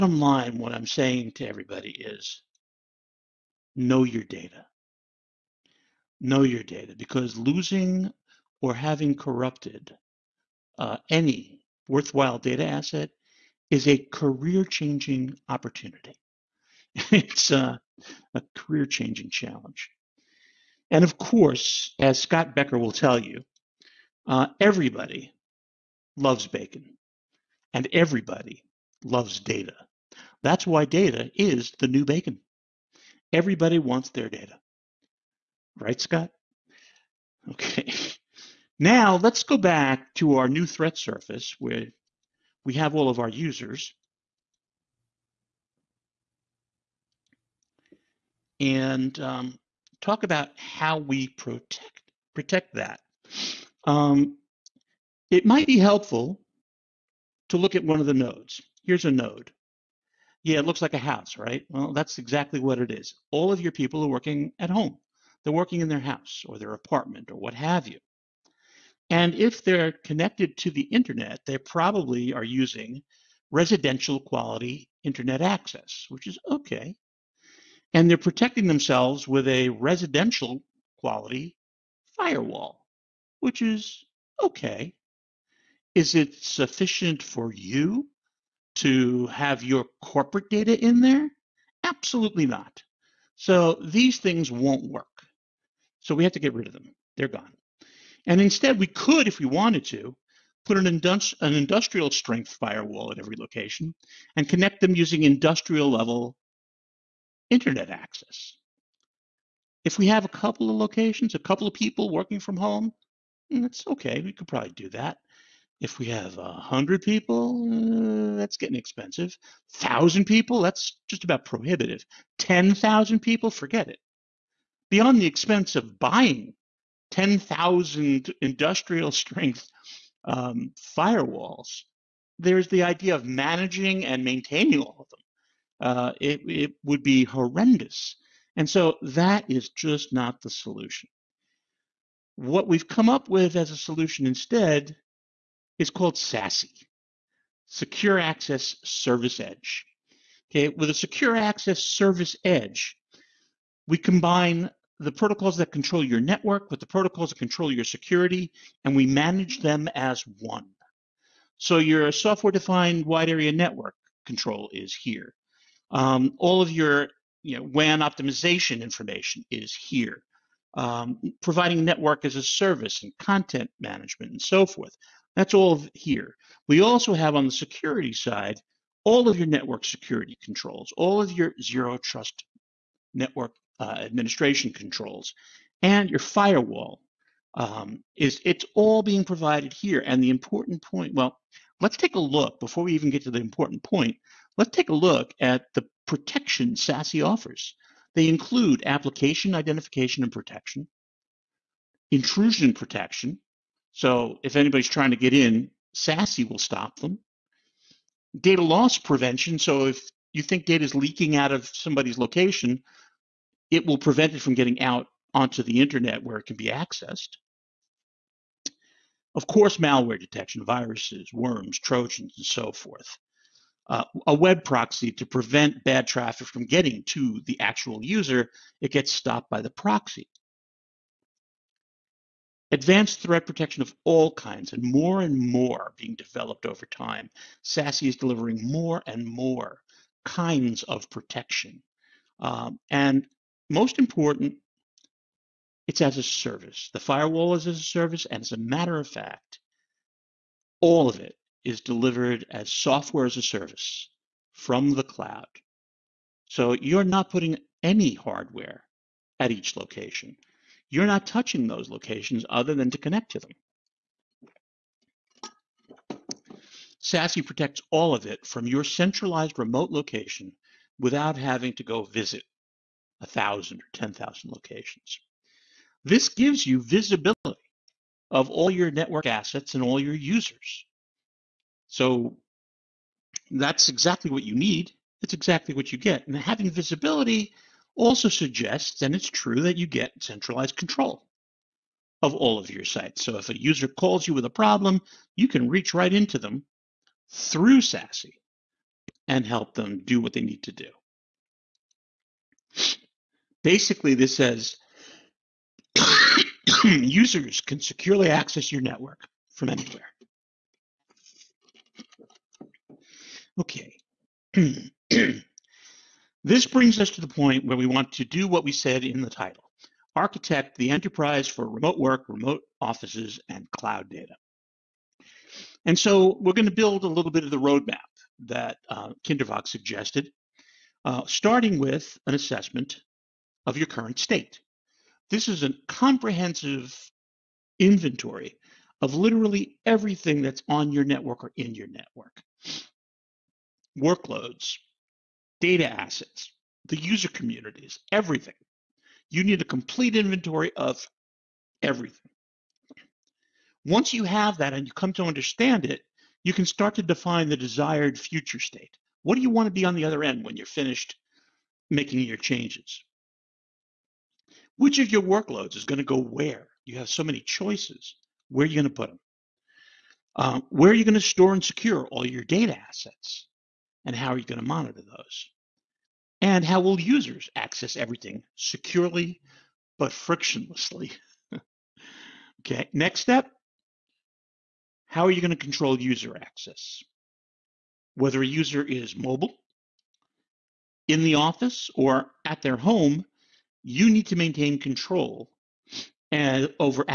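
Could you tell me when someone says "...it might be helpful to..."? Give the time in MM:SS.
00:55.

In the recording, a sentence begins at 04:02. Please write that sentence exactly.
Um, and most important, it's as a service.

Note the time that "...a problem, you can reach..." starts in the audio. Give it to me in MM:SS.
04:54.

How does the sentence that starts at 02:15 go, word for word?
Uh, it, it would be horrendous.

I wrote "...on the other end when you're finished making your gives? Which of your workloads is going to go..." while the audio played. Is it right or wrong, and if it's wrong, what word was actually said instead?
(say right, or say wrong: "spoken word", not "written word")
wrong: "changes", not "gives".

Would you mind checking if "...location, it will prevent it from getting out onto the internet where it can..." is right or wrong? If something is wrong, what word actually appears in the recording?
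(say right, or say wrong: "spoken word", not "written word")
right.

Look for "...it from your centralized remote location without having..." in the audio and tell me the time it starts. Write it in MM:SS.
04:28.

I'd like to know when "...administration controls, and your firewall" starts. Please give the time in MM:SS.
03:03.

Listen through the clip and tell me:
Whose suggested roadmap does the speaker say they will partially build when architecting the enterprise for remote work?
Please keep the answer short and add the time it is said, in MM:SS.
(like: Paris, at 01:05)
Kindervag, at 05:29.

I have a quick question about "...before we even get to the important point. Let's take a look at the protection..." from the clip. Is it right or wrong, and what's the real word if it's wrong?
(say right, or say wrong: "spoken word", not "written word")
right.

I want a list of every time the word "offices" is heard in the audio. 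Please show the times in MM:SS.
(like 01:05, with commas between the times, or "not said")
05:22, 06:31.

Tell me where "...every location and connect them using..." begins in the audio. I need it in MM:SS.
01:43.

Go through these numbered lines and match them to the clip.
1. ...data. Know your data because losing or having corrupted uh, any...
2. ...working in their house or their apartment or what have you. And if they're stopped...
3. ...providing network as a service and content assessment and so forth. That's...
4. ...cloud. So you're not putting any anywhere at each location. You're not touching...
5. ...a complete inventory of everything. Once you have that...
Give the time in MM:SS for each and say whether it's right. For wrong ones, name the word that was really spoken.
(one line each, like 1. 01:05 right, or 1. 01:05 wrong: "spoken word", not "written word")
1. 00:04 right
2. 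01:05 wrong: "connected", not "stopped"
3. 02:51 wrong: "management", not "assessment"
4. 04:15 wrong: "hardware", not "anywhere"
5. 05:49 right.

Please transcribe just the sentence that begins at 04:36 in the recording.
This gives you visibility of all your network assets and all your users.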